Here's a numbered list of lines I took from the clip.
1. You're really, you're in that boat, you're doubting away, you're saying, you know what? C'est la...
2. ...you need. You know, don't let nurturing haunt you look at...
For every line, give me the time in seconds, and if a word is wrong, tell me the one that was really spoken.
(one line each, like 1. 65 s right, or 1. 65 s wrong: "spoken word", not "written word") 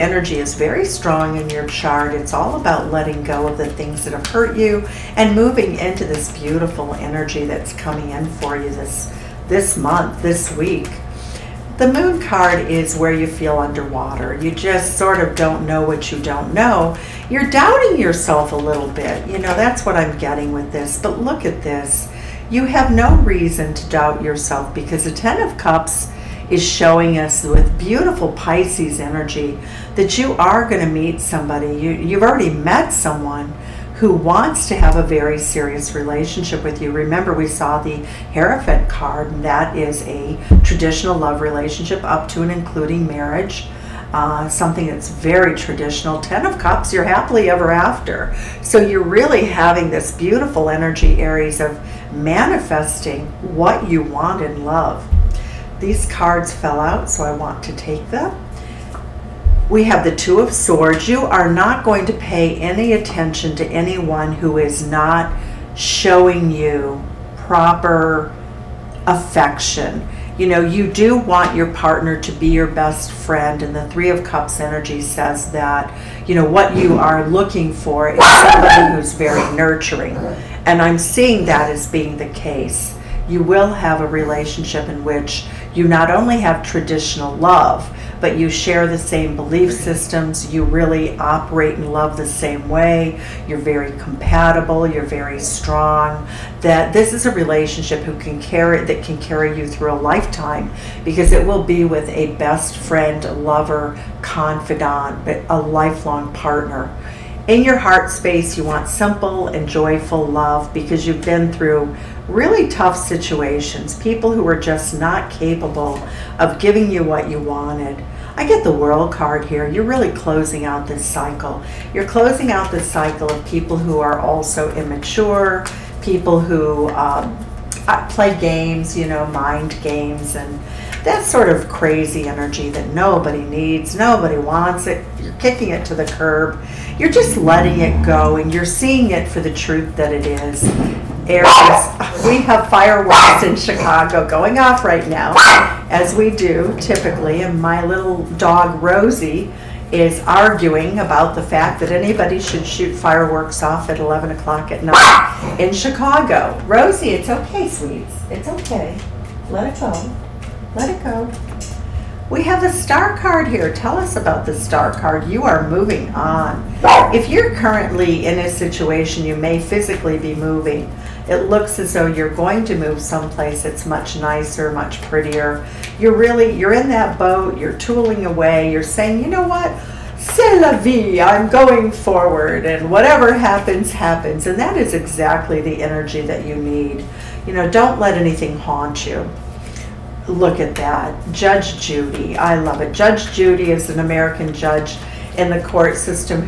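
1. 175 s wrong: "tooling", not "doubting"
2. 186 s wrong: "anything", not "nurturing".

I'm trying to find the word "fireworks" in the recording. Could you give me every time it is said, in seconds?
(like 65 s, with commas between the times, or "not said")
142 s, 152 s.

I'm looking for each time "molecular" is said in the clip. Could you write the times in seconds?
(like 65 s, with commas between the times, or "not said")
not said.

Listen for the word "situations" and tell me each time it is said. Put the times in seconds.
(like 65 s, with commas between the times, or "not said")
112 s, 168 s.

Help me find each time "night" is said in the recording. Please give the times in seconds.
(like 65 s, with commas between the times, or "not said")
154 s.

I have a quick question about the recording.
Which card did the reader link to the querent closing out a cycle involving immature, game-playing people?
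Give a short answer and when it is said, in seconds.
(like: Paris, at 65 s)
The World, at 118 s.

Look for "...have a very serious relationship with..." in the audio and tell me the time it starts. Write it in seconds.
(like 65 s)
34 s.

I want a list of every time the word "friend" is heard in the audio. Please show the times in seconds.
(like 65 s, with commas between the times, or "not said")
73 s, 102 s.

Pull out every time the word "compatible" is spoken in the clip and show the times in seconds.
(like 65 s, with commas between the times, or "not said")
93 s.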